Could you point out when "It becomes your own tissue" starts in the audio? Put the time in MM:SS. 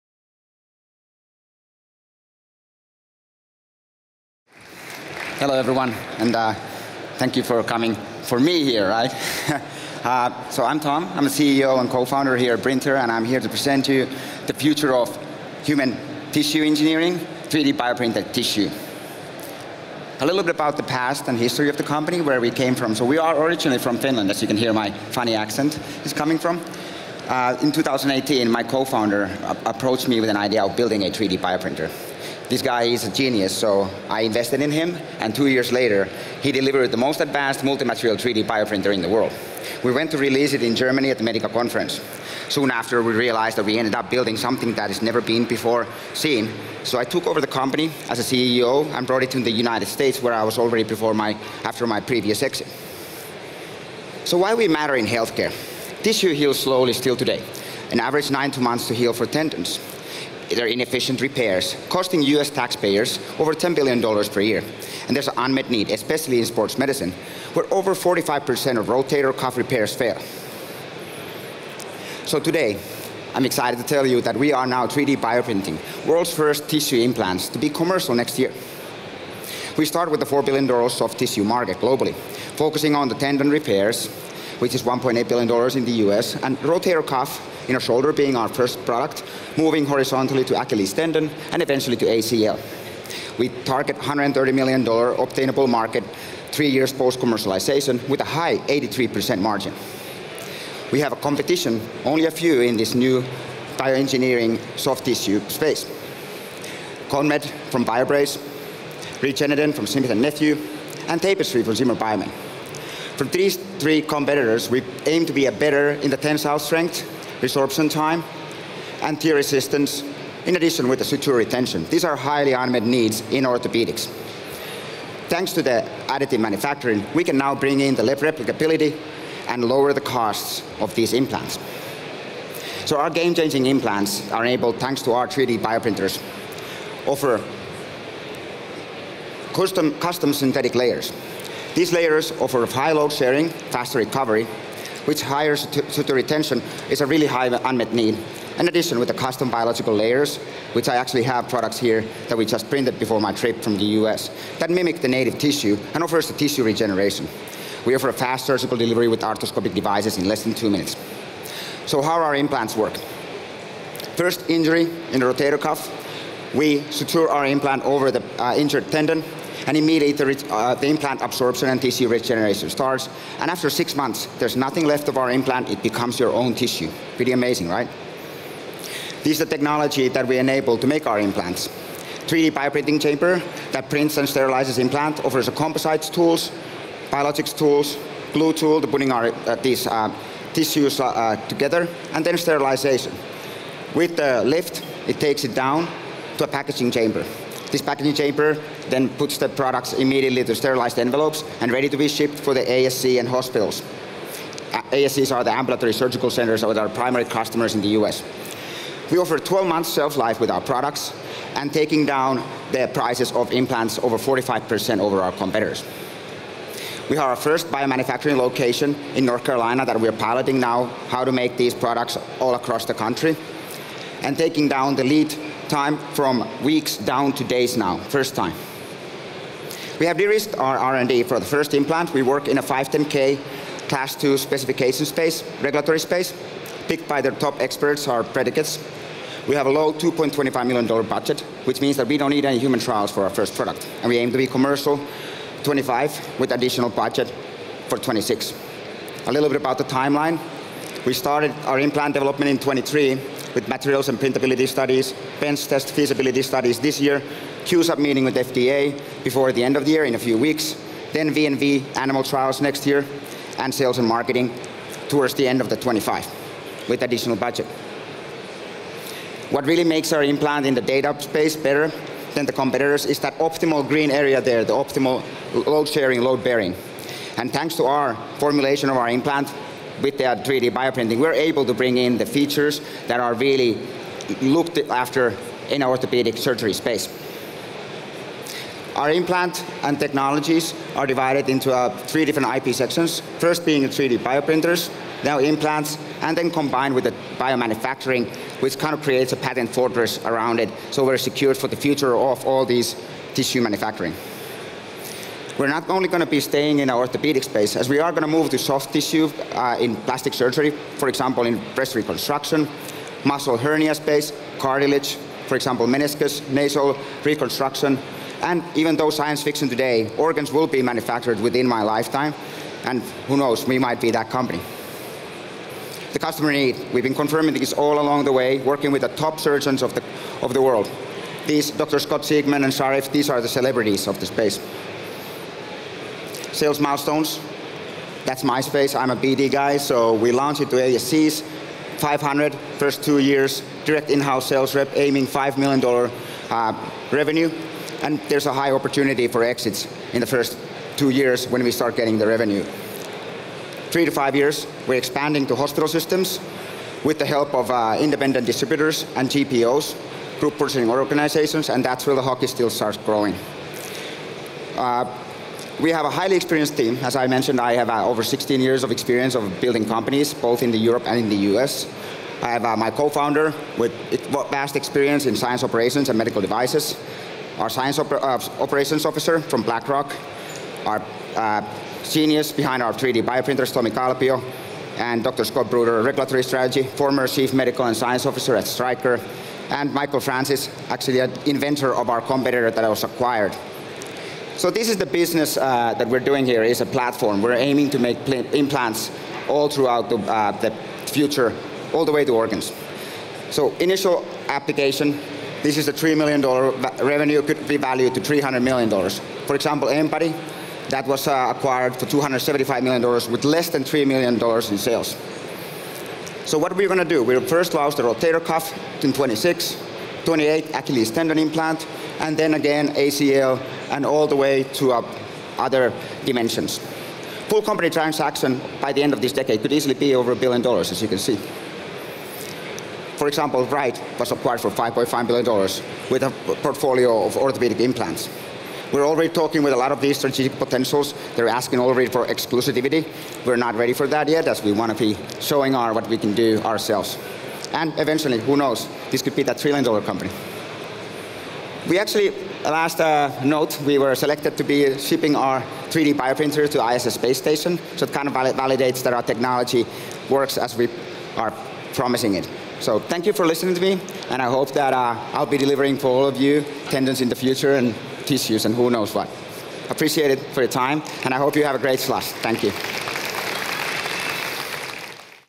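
02:55.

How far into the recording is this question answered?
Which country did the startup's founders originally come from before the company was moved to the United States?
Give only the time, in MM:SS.
00:23.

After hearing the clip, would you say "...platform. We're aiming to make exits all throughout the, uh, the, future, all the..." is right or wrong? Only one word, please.
wrong.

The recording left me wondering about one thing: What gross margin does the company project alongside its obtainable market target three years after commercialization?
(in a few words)
83%.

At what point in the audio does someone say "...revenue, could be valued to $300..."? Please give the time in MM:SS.
06:47.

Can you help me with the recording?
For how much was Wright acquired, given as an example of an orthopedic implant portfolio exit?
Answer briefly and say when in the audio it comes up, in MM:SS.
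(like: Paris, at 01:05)
$5.5 billion, at 07:14.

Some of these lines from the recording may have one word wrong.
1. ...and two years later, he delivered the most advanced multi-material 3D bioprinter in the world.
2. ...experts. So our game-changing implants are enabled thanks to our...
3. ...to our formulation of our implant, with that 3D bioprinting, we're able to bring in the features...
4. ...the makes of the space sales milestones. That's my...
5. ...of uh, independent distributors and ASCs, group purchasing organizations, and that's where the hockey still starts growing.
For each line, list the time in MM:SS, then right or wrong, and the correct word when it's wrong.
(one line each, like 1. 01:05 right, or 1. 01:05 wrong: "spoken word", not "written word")
1. 00:35 right
2. 02:11 wrong: "implants", not "experts"
3. 04:37 right
4. 05:33 wrong: "celebrities", not "makes"
5. 05:57 wrong: "GPOs", not "ASCs".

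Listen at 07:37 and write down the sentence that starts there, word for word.
So it kind of valid validates that our technology works as we are promising it.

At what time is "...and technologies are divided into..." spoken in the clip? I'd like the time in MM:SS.
04:49.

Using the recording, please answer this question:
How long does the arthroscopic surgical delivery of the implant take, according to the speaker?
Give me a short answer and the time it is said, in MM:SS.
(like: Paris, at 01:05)
less than 2 minutes, at 02:40.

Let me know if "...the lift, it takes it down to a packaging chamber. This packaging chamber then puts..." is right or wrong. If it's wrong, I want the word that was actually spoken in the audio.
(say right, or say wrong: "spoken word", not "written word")
right.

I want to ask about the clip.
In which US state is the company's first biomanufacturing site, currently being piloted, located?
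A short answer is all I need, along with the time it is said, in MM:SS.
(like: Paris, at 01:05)
North Carolina, at 03:39.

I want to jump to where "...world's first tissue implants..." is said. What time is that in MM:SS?
01:16.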